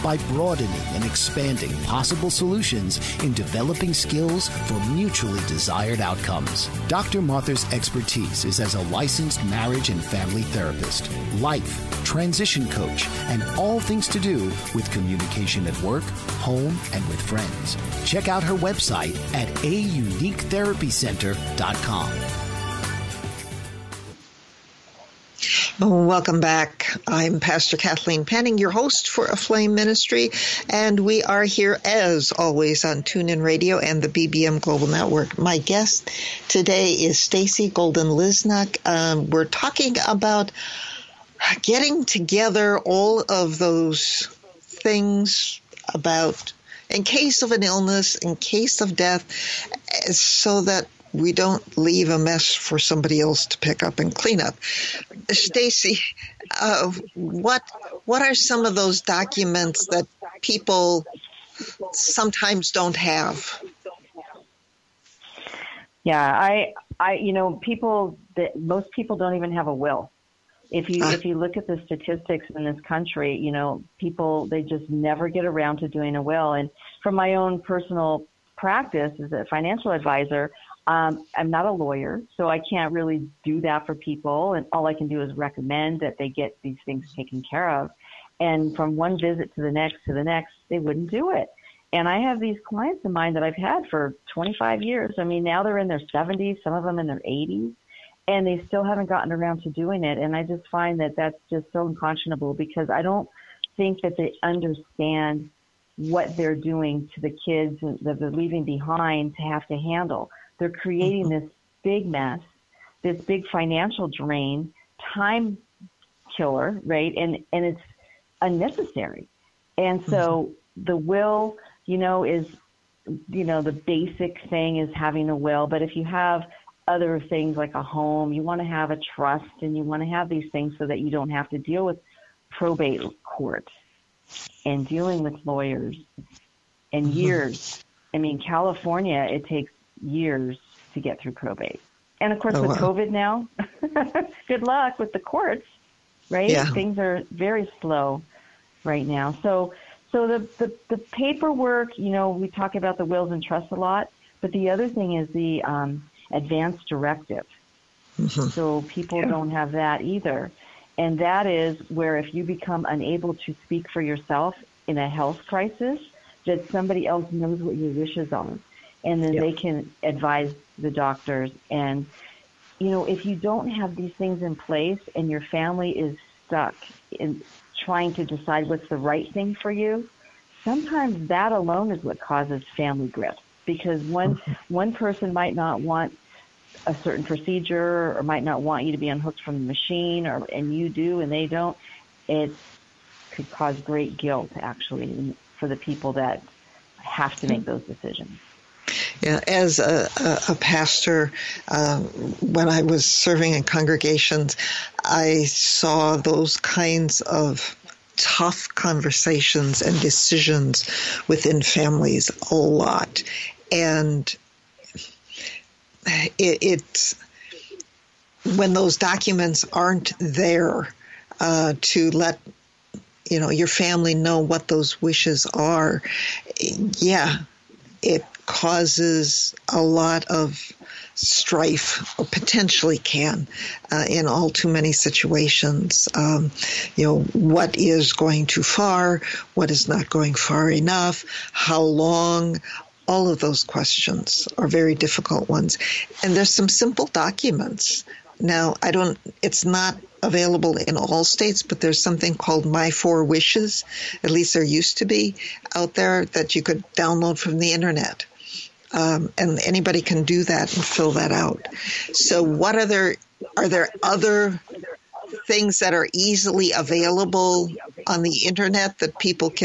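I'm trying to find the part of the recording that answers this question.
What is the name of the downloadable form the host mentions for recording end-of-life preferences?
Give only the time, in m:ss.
4:12.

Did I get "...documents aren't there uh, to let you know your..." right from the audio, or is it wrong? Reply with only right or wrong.
right.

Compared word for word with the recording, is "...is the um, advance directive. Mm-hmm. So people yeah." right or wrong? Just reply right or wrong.
right.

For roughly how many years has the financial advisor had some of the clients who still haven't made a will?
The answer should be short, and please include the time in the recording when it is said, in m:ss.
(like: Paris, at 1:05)
25, at 1:34.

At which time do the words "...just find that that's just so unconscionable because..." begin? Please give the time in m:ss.
1:40.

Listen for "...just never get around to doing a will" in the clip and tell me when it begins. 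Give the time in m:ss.
1:14.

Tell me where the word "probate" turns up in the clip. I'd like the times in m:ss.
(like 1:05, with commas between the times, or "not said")
2:12, 2:21.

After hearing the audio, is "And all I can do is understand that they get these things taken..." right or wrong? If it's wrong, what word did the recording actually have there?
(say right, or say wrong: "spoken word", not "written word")
wrong: "recommend", not "understand".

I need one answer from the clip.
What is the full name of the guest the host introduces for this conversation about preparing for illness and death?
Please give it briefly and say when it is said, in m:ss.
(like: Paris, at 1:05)
Stacey Golden Lisnock, at 0:37.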